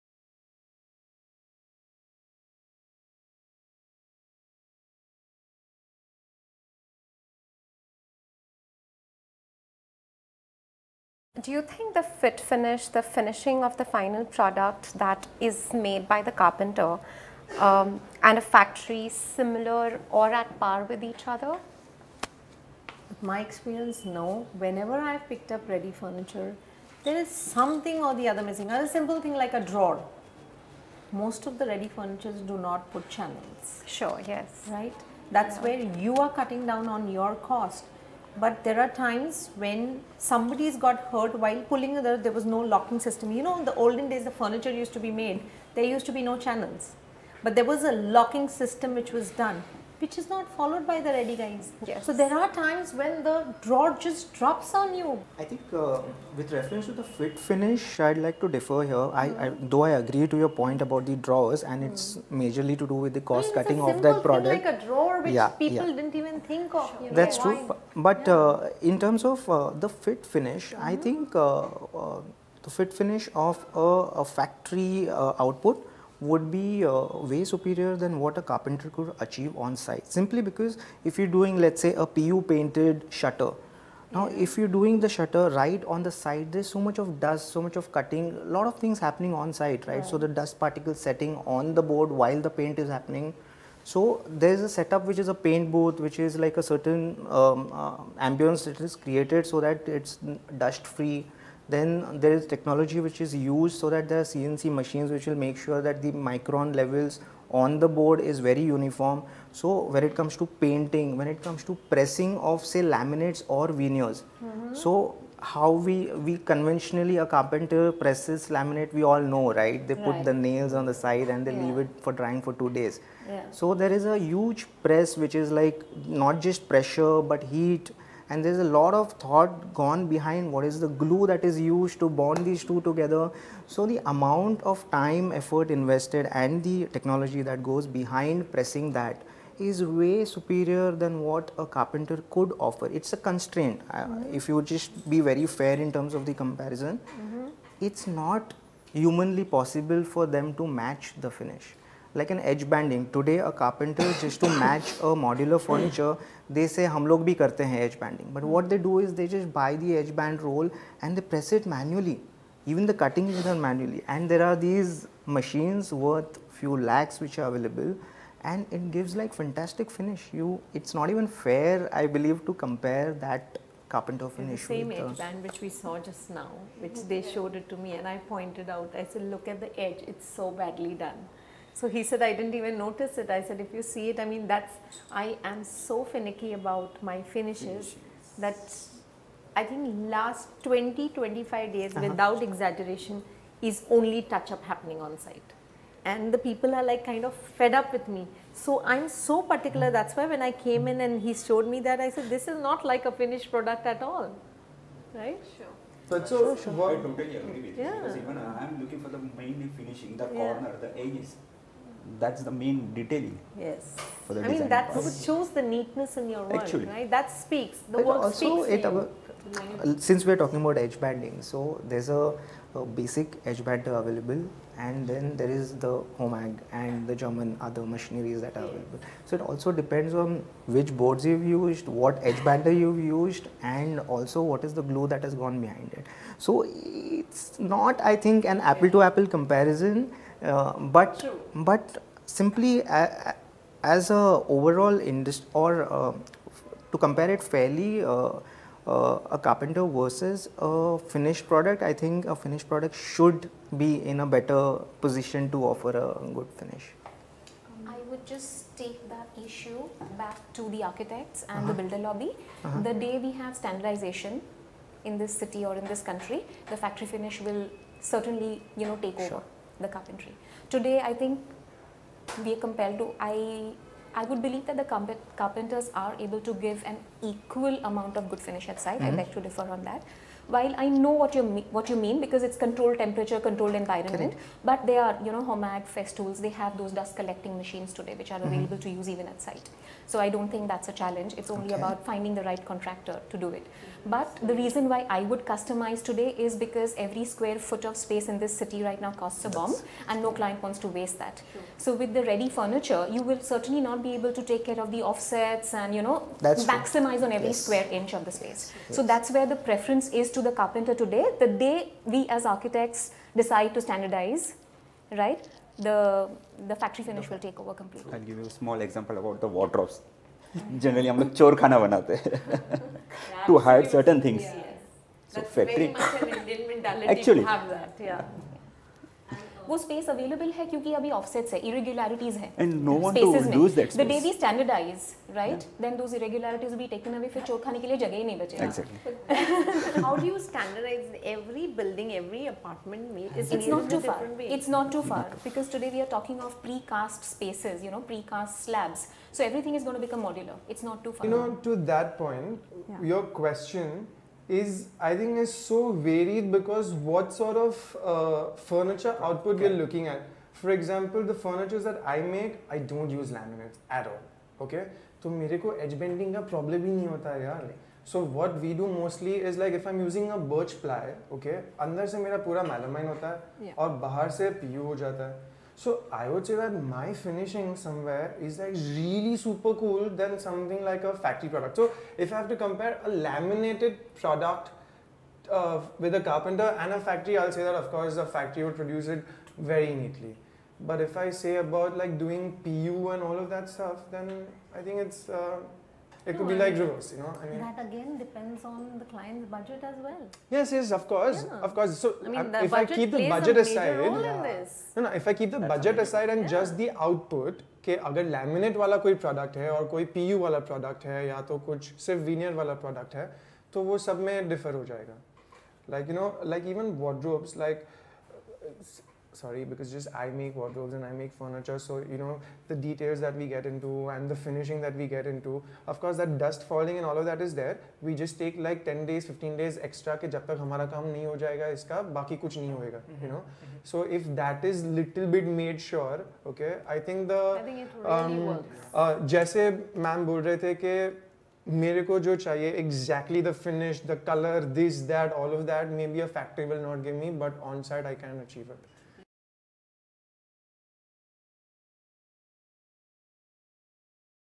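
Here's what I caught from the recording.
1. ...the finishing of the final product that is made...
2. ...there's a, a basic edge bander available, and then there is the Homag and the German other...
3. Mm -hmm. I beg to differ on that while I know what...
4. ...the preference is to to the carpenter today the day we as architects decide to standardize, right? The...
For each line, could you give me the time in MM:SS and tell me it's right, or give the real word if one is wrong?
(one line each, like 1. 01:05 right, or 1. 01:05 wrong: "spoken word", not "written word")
1. 00:12 right
2. 03:41 right
3. 04:38 right
4. 05:09 right.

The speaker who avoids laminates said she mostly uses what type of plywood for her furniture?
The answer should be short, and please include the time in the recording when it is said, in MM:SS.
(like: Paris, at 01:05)
birch ply, at 06:10.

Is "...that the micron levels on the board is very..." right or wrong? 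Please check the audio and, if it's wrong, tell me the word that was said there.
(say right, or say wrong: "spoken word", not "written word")
right.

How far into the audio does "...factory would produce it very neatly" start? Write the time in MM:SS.
06:28.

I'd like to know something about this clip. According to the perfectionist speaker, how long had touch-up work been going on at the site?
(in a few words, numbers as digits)
20-25 days.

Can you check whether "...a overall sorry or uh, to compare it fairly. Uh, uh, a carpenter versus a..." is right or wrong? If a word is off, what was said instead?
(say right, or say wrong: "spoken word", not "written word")
wrong: "industry", not "sorry".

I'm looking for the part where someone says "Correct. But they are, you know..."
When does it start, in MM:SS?
04:44.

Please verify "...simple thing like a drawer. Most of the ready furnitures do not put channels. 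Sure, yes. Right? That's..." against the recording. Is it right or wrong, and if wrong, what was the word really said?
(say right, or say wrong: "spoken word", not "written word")
right.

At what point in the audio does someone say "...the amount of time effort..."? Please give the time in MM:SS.
02:13.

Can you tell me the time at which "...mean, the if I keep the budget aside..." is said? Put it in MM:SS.
06:42.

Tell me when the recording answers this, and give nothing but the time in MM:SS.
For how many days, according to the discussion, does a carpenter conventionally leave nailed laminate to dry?
02:02.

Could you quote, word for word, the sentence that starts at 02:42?
Even the cutting is done manually.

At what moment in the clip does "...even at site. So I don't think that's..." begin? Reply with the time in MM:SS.
04:49.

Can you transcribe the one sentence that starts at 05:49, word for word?
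So everything is going to become modular.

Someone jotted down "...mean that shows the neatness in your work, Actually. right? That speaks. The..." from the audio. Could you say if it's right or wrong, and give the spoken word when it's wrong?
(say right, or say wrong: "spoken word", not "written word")
right.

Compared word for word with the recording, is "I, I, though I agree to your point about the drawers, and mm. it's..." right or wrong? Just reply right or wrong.
right.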